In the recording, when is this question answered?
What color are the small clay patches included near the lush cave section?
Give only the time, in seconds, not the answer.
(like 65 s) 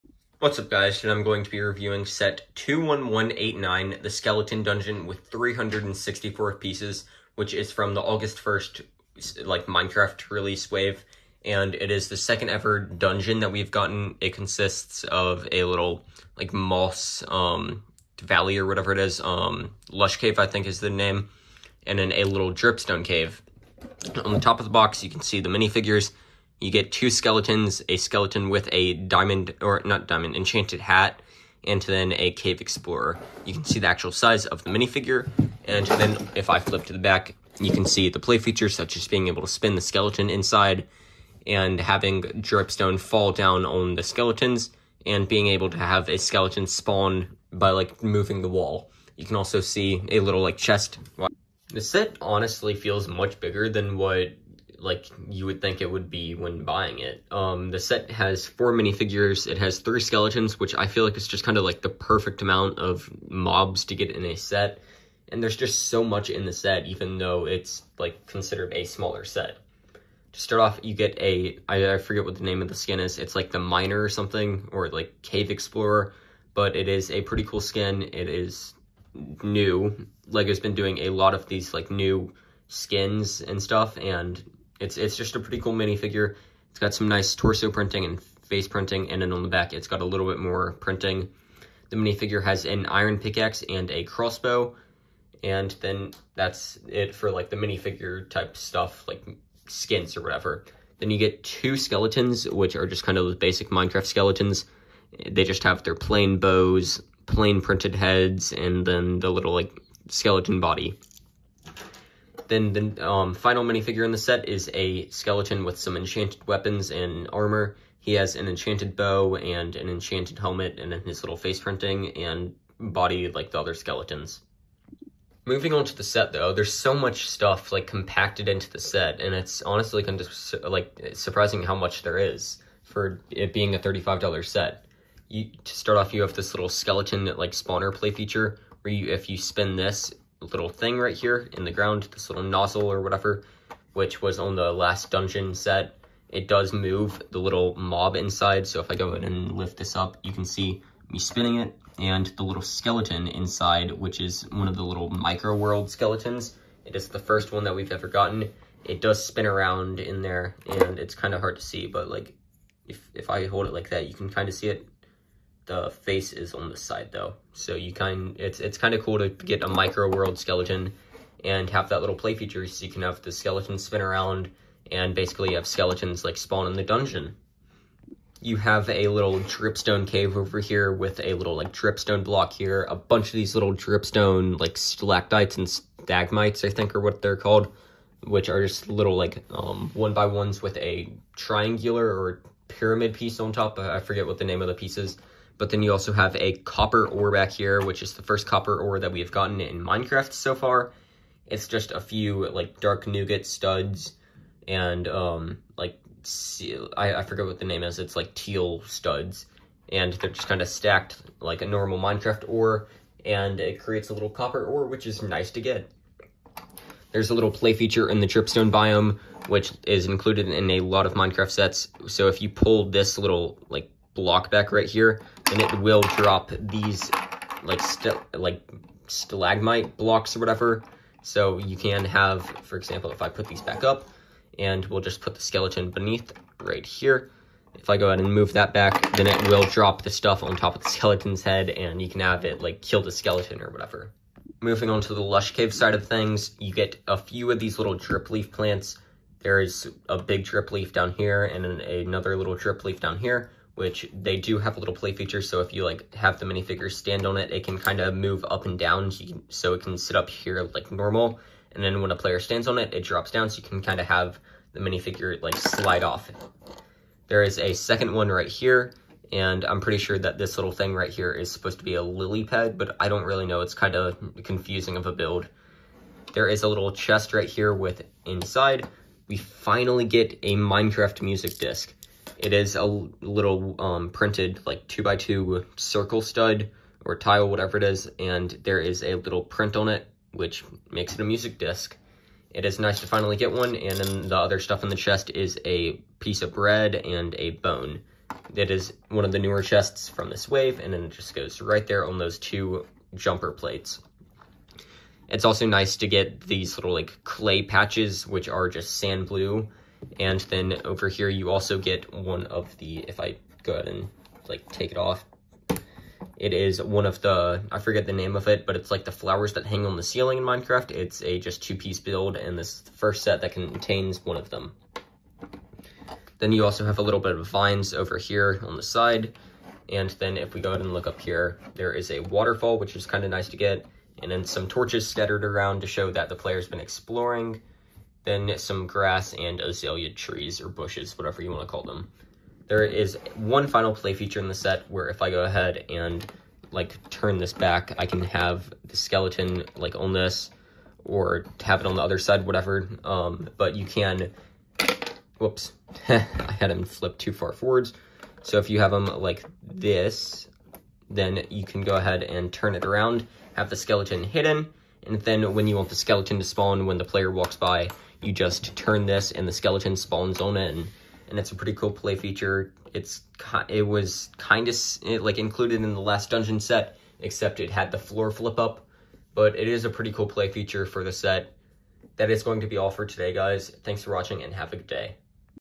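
308 s.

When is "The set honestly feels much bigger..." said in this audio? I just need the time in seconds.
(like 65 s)
51 s.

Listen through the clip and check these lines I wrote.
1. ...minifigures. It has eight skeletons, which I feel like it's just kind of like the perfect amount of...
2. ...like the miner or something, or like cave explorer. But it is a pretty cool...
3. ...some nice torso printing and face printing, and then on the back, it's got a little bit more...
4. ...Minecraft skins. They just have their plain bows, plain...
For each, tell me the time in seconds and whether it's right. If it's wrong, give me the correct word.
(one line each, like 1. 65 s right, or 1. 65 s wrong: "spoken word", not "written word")
1. 58 s wrong: "three", not "eight"
2. 73 s right
3. 86 s right
4. 103 s wrong: "skeletons", not "skins".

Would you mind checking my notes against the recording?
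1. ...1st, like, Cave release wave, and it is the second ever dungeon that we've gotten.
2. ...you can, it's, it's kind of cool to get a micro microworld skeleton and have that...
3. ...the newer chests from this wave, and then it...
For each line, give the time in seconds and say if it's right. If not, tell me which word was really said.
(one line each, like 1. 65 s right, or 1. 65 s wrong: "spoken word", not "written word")
1. 8 s wrong: "Minecraft", not "Cave"
2. 167 s wrong: "world", not "microworld"
3. 299 s right.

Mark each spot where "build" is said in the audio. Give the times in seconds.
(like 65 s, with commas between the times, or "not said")
275 s, 321 s.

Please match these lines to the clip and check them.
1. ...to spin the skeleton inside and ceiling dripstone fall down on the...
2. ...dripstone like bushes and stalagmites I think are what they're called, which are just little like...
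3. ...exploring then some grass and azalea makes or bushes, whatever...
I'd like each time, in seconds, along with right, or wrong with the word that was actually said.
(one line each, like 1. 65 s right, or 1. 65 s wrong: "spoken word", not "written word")
1. 39 s wrong: "having", not "ceiling"
2. 183 s wrong: "stalactites", not "bushes"
3. 336 s wrong: "trees", not "makes".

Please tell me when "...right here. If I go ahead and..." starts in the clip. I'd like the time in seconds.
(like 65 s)
236 s.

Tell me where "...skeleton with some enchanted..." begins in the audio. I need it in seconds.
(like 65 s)
115 s.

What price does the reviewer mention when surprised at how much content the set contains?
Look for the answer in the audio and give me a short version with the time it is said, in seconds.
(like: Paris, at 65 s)
$35, at 133 s.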